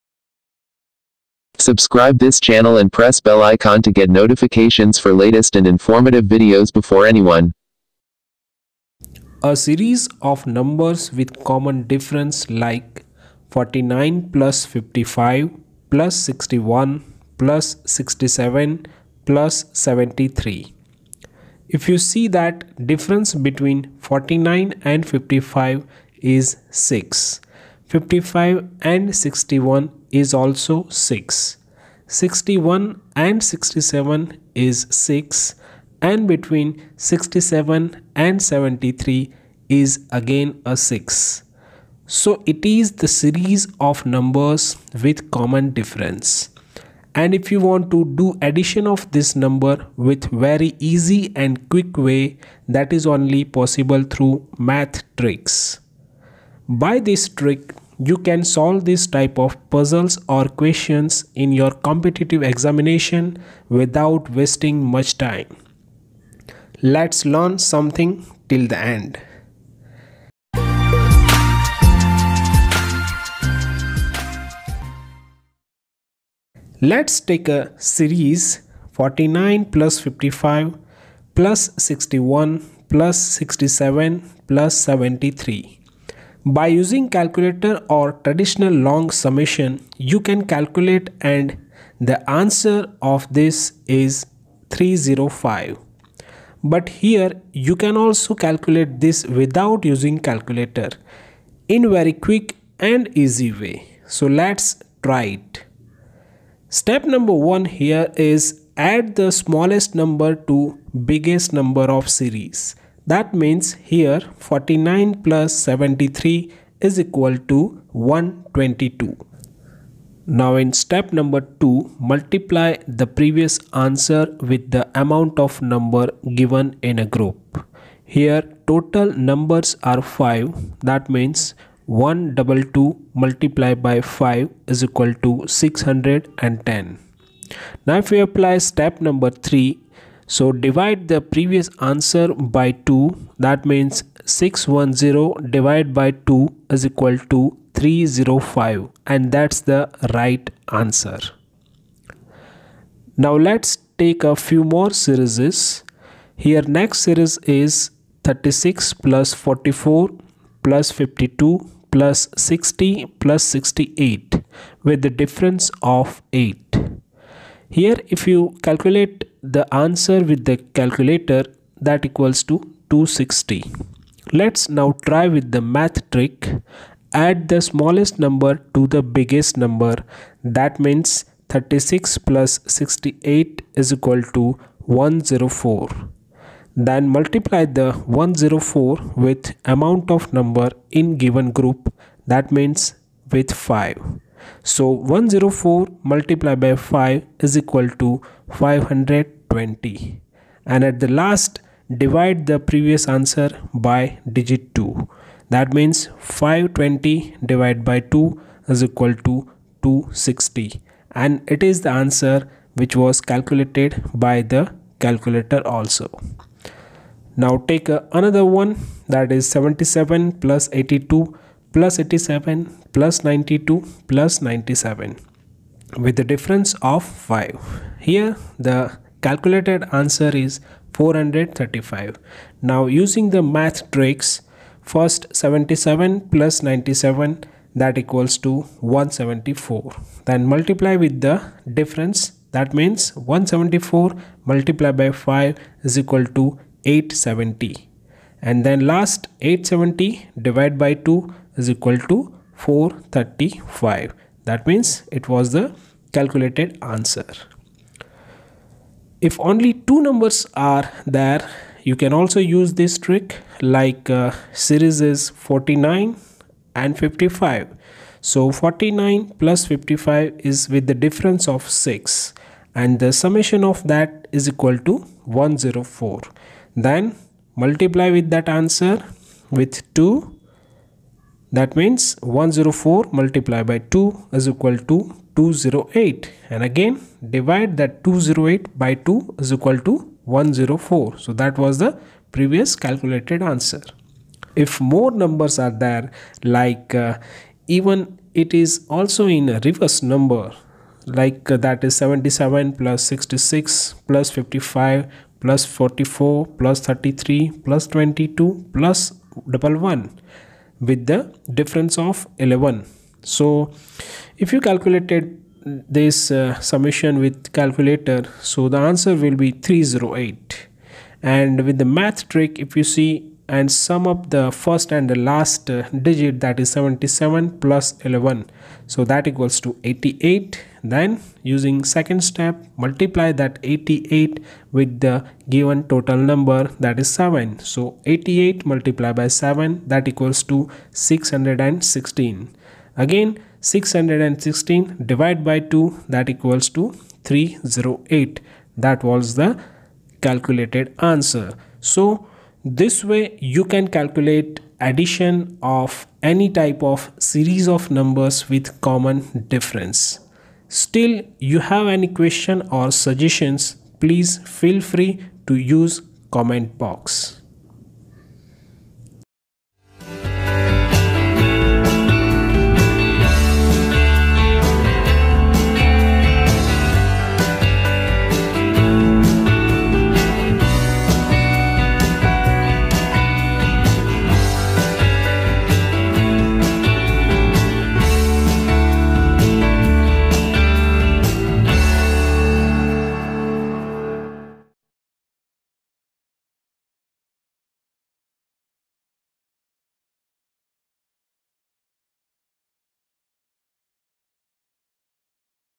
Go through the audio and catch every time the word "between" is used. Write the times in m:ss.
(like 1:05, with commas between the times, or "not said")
0:23, 0:36.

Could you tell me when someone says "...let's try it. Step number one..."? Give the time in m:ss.
1:44.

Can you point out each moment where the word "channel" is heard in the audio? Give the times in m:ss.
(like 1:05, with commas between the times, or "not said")
0:02.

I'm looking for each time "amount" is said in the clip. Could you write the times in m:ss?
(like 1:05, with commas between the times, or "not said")
2:05, 3:09.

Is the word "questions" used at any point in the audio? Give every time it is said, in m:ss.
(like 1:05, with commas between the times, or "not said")
1:00, 6:02.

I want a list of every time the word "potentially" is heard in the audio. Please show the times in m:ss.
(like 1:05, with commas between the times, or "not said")
not said.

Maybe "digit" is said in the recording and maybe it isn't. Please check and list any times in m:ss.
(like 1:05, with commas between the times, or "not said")
3:24, 5:26.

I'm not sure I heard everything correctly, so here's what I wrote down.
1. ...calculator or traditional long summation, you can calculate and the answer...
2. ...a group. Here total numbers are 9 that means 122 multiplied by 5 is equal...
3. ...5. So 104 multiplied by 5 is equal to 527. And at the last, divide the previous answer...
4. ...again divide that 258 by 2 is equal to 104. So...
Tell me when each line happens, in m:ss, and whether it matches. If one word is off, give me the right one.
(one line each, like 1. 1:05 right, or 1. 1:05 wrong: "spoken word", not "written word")
1. 1:27 right
2. 2:06 wrong: "5", not "9"
3. 3:13 wrong: "520", not "527"
4. 4:46 wrong: "208", not "258".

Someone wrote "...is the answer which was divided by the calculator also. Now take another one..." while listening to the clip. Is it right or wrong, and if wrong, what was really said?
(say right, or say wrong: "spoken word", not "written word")
wrong: "calculated", not "divided".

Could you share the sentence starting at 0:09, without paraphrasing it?
A series of numbers with common difference like 49 plus 55 plus 61 plus 67 plus 73.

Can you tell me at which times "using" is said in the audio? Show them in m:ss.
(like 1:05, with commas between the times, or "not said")
1:26, 1:39, 3:52, 5:31.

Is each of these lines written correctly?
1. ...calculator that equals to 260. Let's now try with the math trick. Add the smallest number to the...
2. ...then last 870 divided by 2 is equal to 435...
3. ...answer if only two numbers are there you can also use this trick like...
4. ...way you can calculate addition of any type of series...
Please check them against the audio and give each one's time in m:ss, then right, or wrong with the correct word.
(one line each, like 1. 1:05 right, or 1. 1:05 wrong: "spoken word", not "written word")
1. 2:50 right
2. 4:08 right
3. 4:16 right
4. 5:53 right.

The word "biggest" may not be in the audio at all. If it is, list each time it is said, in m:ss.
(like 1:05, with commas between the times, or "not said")
1:51, 2:59.